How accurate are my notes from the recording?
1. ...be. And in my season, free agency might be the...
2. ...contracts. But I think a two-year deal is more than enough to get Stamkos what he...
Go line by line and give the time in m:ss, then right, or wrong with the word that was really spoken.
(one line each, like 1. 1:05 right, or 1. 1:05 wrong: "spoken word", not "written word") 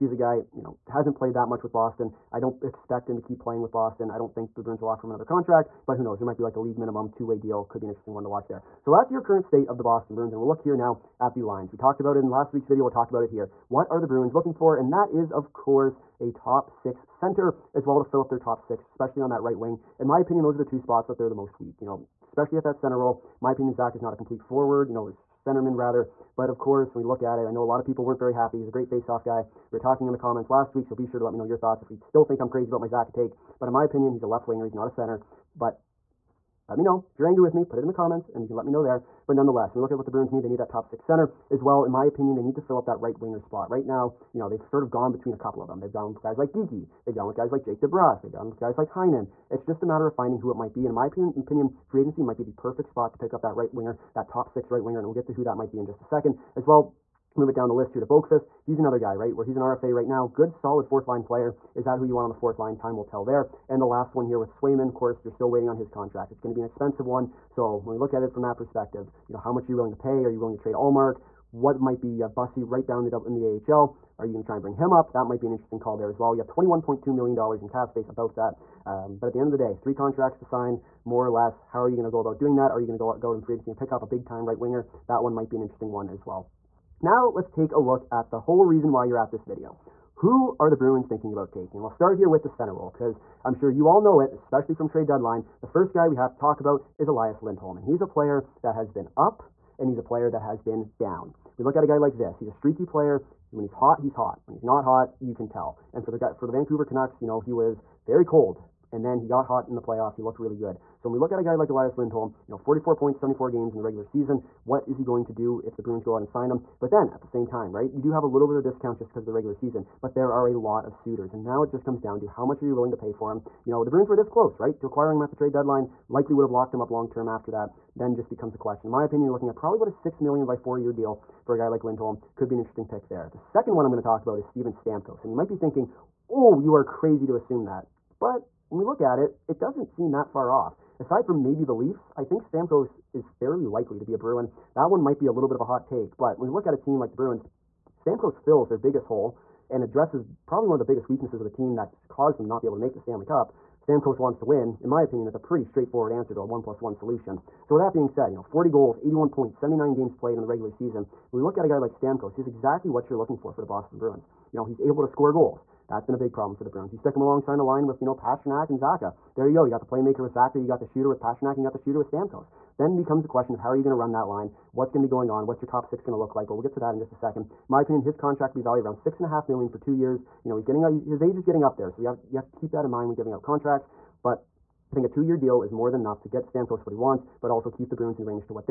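1. 0:50 wrong: "opinion", not "season"
2. 3:03 right.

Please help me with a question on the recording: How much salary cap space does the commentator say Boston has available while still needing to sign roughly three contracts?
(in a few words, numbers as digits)
$21.2 million.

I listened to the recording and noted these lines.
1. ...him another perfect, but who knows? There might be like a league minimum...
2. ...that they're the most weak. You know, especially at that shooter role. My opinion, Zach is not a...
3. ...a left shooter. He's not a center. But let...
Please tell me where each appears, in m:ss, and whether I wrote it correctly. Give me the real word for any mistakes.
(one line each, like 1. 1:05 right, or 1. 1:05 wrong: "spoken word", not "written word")
1. 0:05 wrong: "contract", not "perfect"
2. 0:21 wrong: "center", not "shooter"
3. 0:34 wrong: "winger", not "shooter".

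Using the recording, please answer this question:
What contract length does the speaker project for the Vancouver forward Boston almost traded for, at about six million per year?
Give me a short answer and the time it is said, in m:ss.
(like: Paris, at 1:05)
4 years, at 2:10.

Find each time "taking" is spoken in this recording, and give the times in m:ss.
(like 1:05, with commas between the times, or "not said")
1:31.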